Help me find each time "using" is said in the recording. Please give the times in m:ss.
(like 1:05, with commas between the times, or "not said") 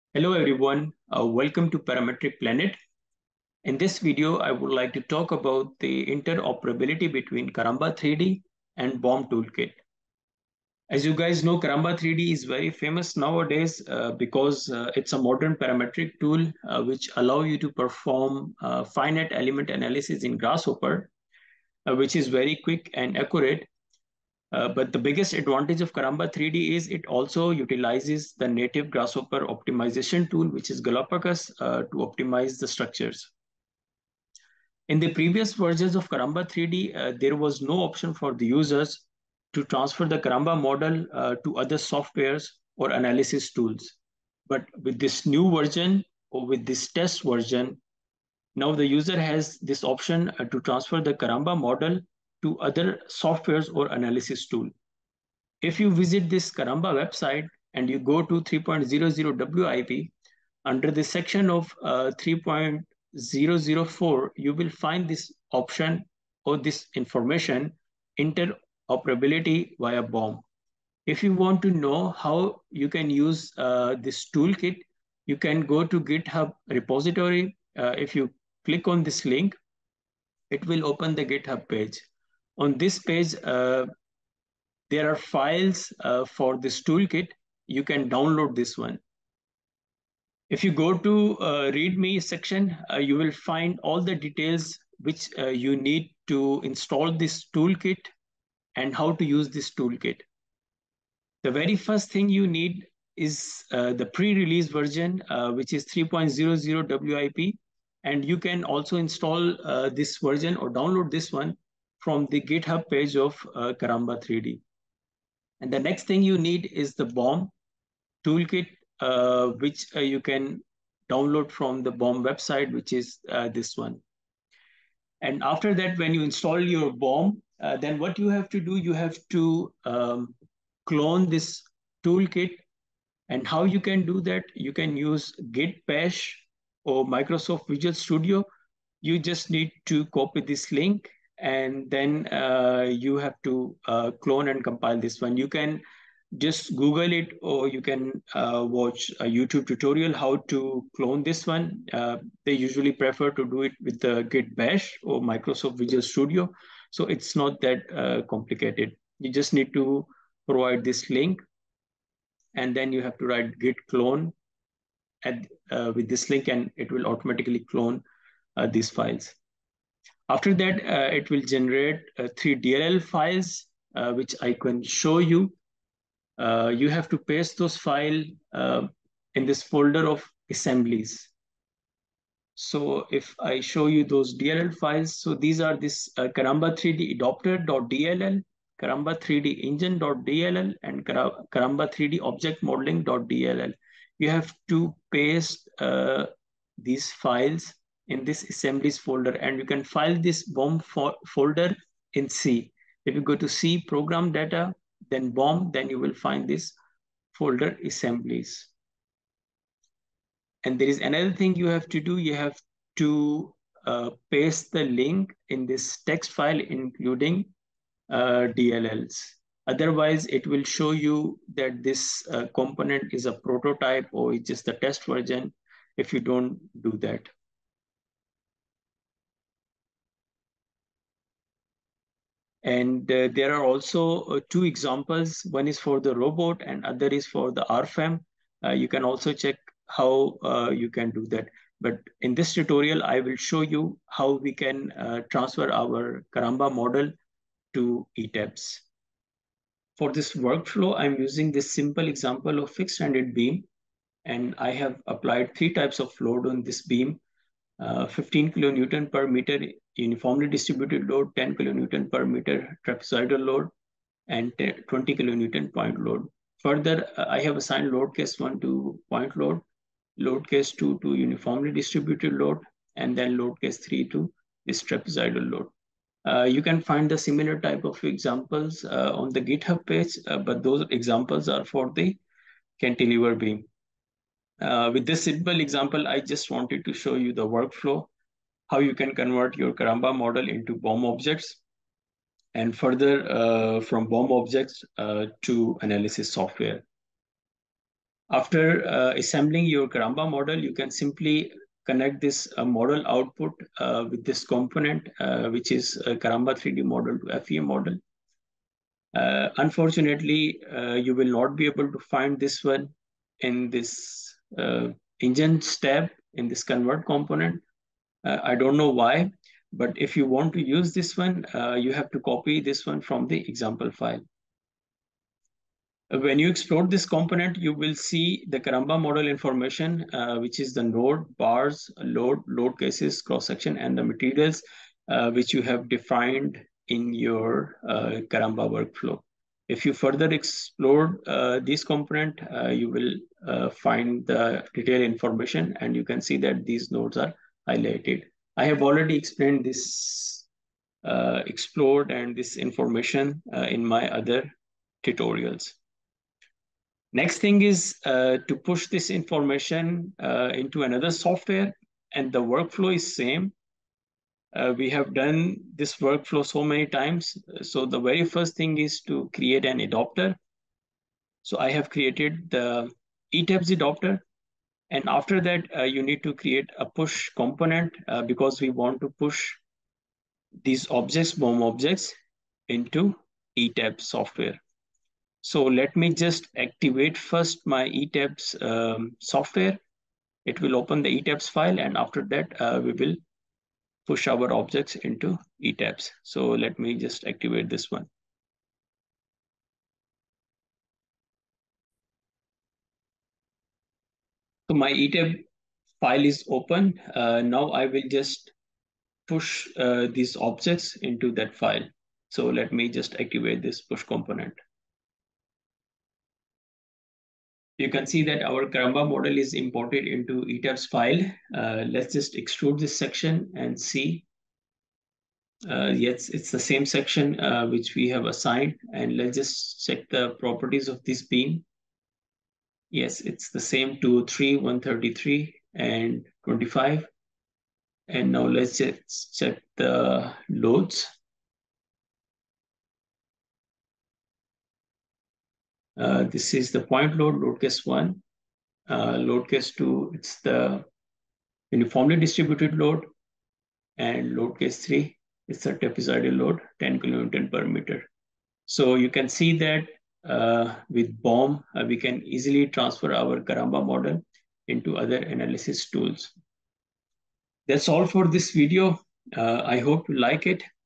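4:11.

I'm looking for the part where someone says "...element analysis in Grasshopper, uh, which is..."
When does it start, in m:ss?
0:19.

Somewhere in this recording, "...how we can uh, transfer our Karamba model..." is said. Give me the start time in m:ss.
4:04.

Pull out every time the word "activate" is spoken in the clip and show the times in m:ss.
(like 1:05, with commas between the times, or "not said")
6:26, 6:37, 6:53.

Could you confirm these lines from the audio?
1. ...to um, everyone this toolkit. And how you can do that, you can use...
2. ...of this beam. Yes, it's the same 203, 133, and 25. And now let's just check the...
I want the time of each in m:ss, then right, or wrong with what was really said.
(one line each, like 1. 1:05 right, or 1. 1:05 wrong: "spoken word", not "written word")
1. 2:09 wrong: "clone", not "everyone"
2. 7:10 right.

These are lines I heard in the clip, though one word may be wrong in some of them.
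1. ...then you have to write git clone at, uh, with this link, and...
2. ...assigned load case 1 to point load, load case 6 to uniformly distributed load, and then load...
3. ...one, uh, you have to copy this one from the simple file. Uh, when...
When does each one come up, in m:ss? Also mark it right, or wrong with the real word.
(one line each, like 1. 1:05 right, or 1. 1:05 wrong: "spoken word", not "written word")
1. 2:42 right
2. 4:27 wrong: "2", not "6"
3. 5:21 wrong: "example", not "simple".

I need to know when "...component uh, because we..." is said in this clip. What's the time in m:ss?
6:17.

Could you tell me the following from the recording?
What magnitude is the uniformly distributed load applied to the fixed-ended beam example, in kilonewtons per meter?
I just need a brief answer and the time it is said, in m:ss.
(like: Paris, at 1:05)
15 kN/m, at 4:18.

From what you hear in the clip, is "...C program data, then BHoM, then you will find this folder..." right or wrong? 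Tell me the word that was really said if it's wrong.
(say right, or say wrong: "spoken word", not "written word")
right.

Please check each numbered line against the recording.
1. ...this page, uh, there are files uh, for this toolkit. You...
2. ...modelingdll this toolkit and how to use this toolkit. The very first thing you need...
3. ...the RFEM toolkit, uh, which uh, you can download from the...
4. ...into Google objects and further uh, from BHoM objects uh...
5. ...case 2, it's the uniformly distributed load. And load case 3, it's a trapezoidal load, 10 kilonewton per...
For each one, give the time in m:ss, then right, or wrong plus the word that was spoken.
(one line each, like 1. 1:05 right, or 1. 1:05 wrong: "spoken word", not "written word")
1. 1:22 right
2. 1:36 wrong: "install", not "modelingdll"
3. 1:56 wrong: "BHoM", not "RFEM"
4. 4:50 wrong: "BHoM", not "Google"
5. 7:29 right.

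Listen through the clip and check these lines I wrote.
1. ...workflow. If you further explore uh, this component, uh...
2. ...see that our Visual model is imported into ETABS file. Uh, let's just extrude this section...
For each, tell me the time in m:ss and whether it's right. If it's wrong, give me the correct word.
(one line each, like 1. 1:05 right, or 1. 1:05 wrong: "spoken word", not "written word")
1. 5:38 right
2. 6:58 wrong: "Karamba", not "Visual".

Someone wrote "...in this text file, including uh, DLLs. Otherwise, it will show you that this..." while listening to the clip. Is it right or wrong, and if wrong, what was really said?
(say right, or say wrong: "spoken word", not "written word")
right.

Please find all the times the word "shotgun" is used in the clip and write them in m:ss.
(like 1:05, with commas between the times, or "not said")
not said.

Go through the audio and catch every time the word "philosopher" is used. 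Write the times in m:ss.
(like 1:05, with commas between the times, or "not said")
not said.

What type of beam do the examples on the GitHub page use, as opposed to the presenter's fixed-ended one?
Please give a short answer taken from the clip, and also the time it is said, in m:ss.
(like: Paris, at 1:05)
Cantilever beam, at 4:42.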